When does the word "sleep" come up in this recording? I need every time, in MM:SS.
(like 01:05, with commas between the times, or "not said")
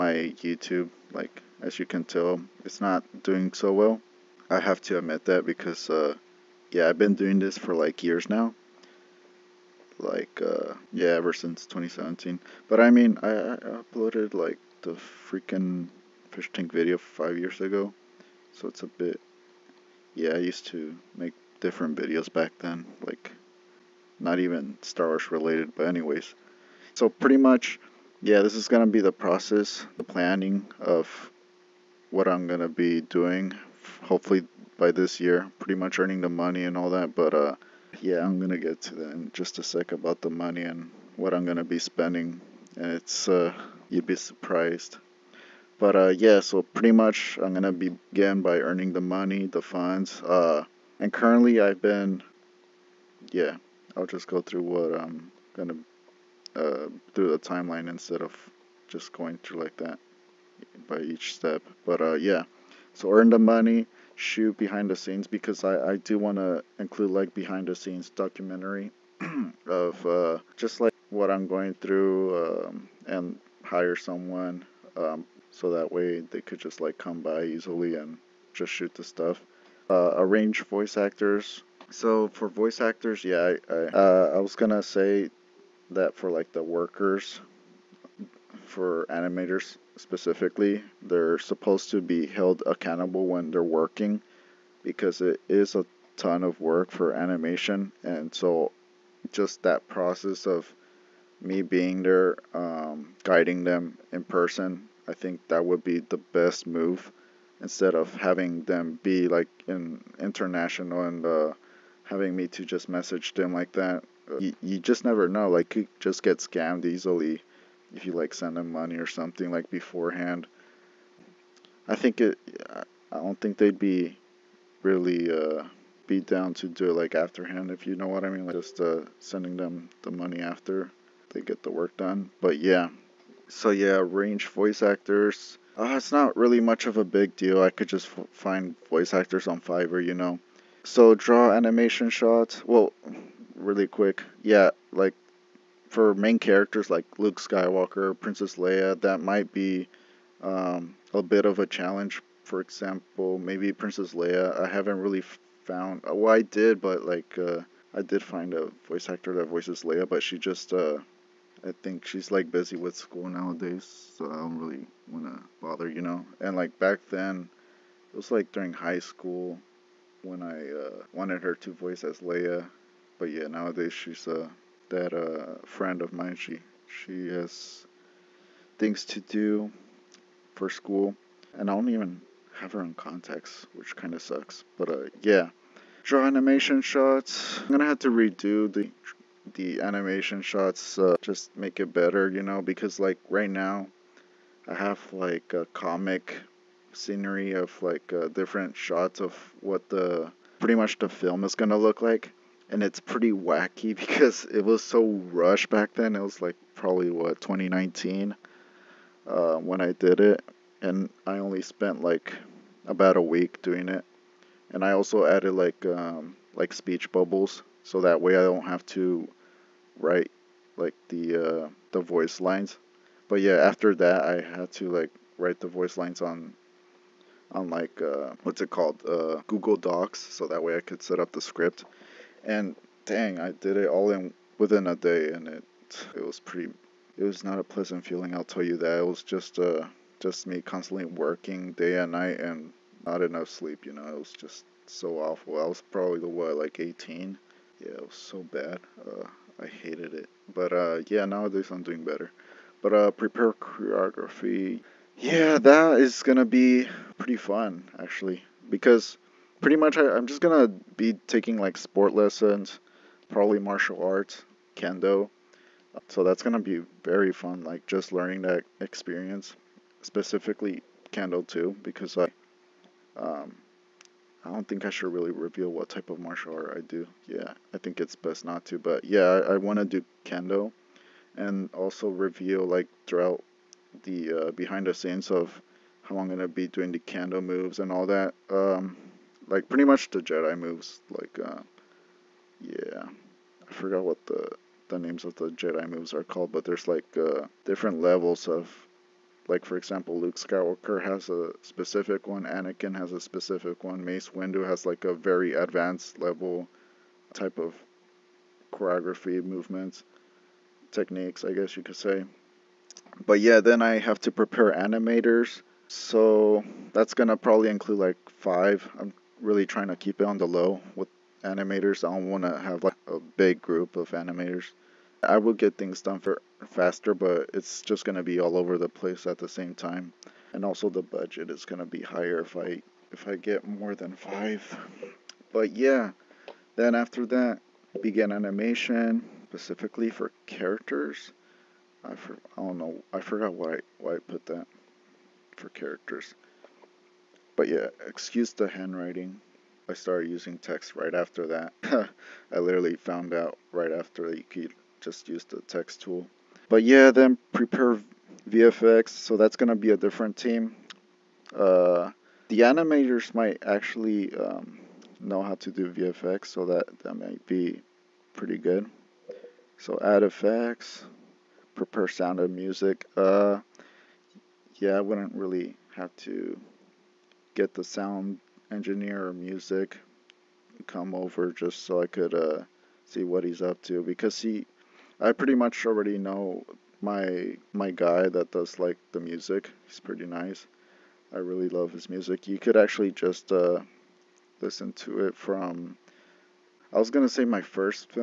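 04:03.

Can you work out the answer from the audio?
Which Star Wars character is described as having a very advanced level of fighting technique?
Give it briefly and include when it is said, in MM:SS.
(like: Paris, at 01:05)
Mace Windu, at 05:04.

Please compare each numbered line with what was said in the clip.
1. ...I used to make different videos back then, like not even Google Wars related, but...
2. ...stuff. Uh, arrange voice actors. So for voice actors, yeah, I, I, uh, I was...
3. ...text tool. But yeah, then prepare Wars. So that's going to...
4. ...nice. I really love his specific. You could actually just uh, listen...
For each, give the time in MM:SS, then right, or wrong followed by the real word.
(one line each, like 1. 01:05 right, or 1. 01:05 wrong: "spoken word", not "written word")
1. 00:20 wrong: "Star", not "Google"
2. 01:19 right
3. 05:55 wrong: "VFX", not "Wars"
4. 06:30 wrong: "music", not "specific".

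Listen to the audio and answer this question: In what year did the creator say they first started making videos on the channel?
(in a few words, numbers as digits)
2017.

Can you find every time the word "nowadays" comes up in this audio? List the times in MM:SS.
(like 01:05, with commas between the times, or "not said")
02:43, 02:53, 04:11.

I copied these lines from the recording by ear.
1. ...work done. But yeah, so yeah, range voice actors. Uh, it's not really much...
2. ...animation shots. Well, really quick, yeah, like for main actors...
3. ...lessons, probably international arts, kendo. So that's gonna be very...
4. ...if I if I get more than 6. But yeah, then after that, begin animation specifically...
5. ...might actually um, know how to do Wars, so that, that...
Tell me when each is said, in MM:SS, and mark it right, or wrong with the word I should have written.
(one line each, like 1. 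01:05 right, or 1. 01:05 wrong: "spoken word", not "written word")
1. 02:11 right
2. 02:21 wrong: "characters", not "actors"
3. 04:22 wrong: "martial", not "international"
4. 05:32 wrong: "5", not "6"
5. 06:03 wrong: "VFX", not "Wars".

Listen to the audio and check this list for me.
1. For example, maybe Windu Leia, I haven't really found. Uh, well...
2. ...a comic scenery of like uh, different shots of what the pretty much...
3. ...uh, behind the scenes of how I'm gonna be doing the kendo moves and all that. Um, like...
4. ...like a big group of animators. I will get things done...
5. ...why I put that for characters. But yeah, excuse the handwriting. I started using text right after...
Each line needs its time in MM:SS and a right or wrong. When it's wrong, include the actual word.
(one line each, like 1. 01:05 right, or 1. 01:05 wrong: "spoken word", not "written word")
1. 02:32 wrong: "Princess", not "Windu"
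2. 03:15 right
3. 04:44 right
4. 05:22 right
5. 05:43 right.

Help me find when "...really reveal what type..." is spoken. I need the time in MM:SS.
04:35.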